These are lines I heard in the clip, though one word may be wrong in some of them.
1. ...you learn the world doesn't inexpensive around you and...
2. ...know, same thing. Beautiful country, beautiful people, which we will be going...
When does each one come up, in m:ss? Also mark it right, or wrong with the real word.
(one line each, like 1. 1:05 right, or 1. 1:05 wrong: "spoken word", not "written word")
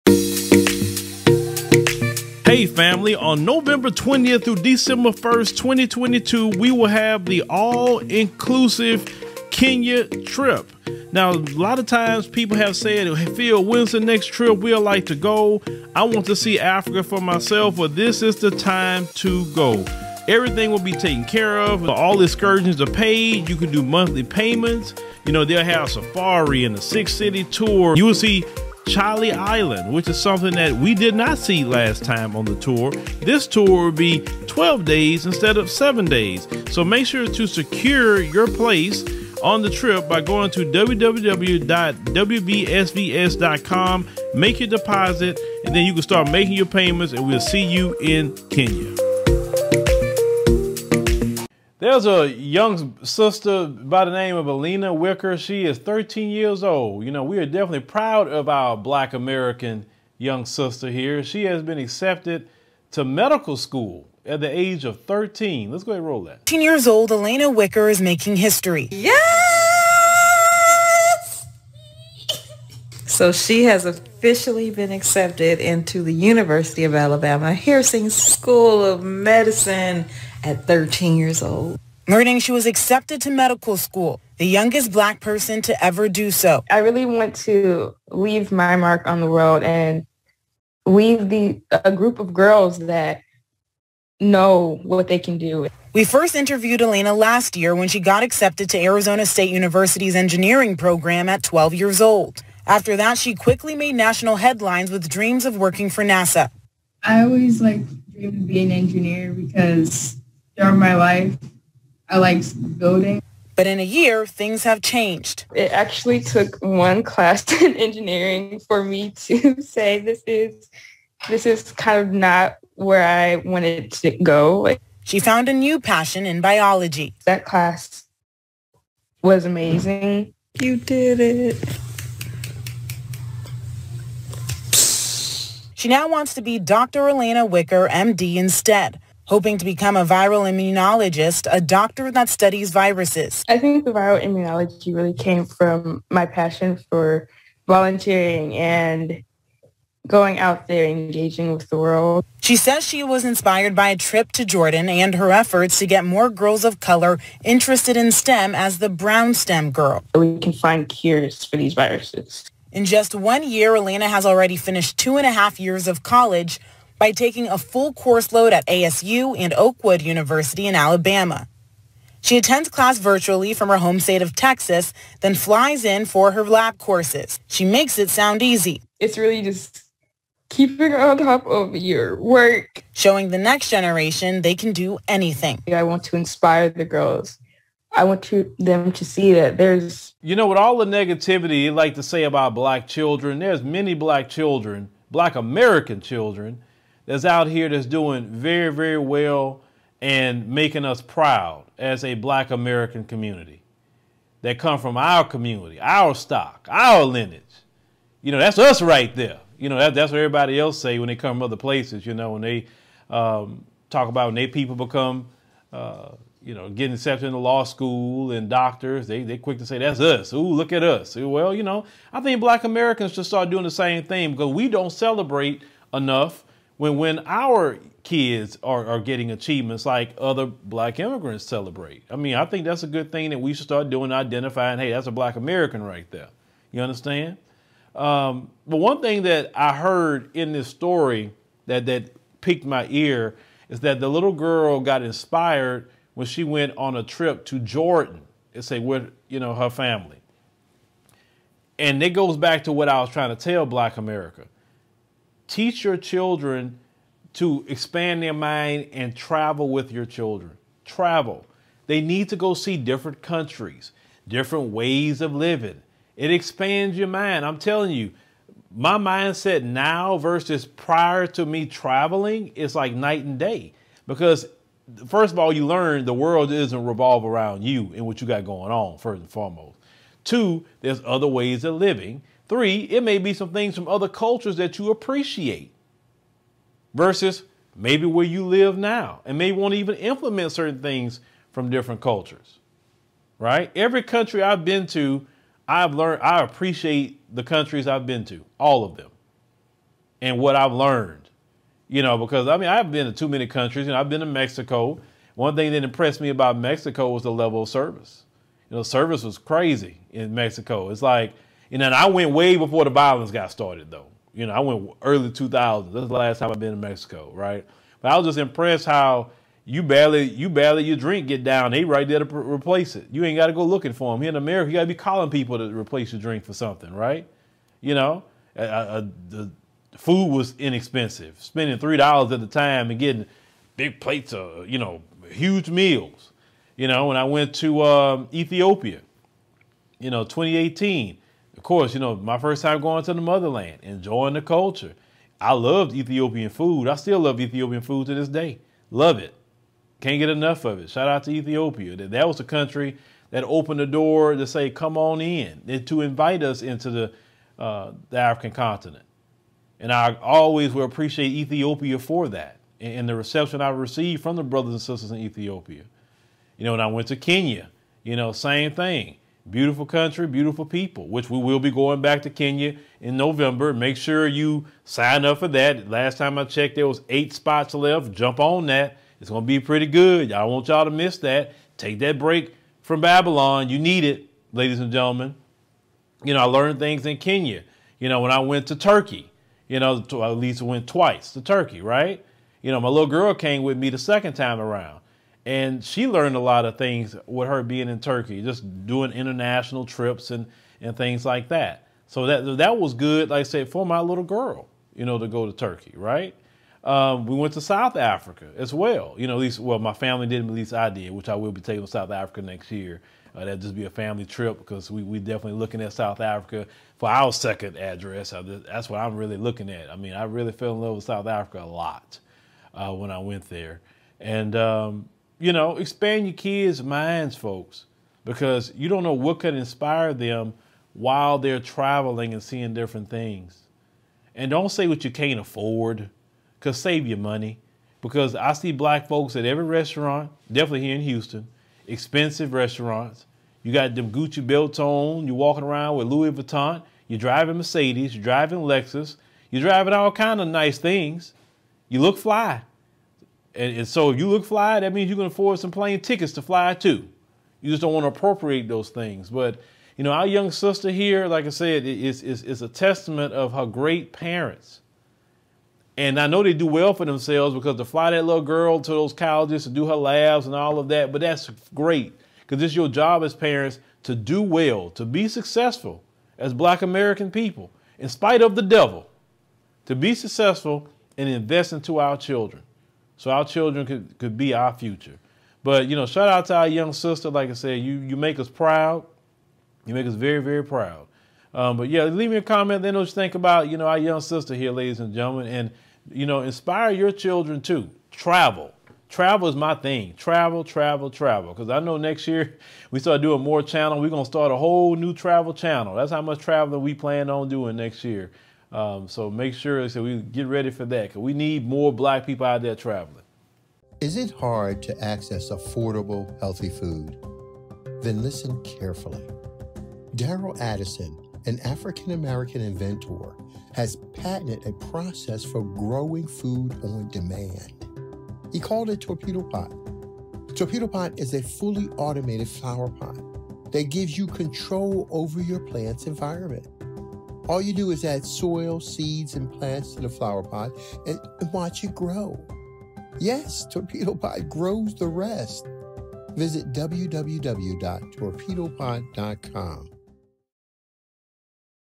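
1. 4:35 wrong: "revolve", not "inexpensive"
2. 6:08 right.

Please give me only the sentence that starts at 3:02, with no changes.
Showing the next generation they can do anything.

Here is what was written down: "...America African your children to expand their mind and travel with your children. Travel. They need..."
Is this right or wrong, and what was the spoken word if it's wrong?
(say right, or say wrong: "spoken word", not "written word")
wrong: "Teach", not "African".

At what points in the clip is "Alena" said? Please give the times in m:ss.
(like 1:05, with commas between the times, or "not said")
0:54, 1:07, 1:36, 2:17, 2:43.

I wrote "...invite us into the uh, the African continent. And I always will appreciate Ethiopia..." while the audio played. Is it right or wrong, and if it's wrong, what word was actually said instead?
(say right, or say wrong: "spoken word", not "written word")
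right.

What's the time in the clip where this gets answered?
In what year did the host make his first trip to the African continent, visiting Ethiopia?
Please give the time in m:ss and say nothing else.
5:40.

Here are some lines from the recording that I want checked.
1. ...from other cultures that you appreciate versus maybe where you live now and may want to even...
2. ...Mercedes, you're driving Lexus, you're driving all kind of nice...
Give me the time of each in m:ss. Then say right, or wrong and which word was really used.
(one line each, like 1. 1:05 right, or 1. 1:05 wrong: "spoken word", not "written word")
1. 4:43 right
2. 7:27 right.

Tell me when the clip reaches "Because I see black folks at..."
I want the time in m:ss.
7:18.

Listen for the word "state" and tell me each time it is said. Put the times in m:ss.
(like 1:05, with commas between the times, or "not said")
1:39, 2:53.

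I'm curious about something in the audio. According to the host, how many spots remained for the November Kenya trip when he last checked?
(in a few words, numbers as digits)
8.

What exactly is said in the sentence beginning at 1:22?
learning she was accepted to medical school, the youngest black person to ever do so.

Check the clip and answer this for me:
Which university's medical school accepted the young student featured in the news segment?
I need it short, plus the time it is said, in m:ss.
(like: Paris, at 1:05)
University of Alabama Heersink School of Medicine, at 1:16.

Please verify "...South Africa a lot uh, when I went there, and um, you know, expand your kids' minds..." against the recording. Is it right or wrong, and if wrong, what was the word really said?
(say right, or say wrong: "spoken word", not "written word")
right.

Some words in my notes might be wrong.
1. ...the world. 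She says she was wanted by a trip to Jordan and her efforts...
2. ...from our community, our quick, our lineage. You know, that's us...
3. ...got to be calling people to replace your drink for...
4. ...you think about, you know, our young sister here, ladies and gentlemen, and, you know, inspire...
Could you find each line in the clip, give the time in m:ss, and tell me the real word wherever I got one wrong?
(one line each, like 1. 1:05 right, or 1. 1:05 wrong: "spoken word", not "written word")
1. 2:31 wrong: "inspired", not "wanted"
2. 3:24 wrong: "stock", not "quick"
3. 5:24 right
4. 8:13 right.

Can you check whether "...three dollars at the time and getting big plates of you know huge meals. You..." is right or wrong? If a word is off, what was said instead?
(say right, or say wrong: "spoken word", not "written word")
right.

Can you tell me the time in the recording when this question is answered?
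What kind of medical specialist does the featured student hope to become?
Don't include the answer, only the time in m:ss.
2:20.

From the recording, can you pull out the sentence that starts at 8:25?
That's how much traveling we plan on doing next year.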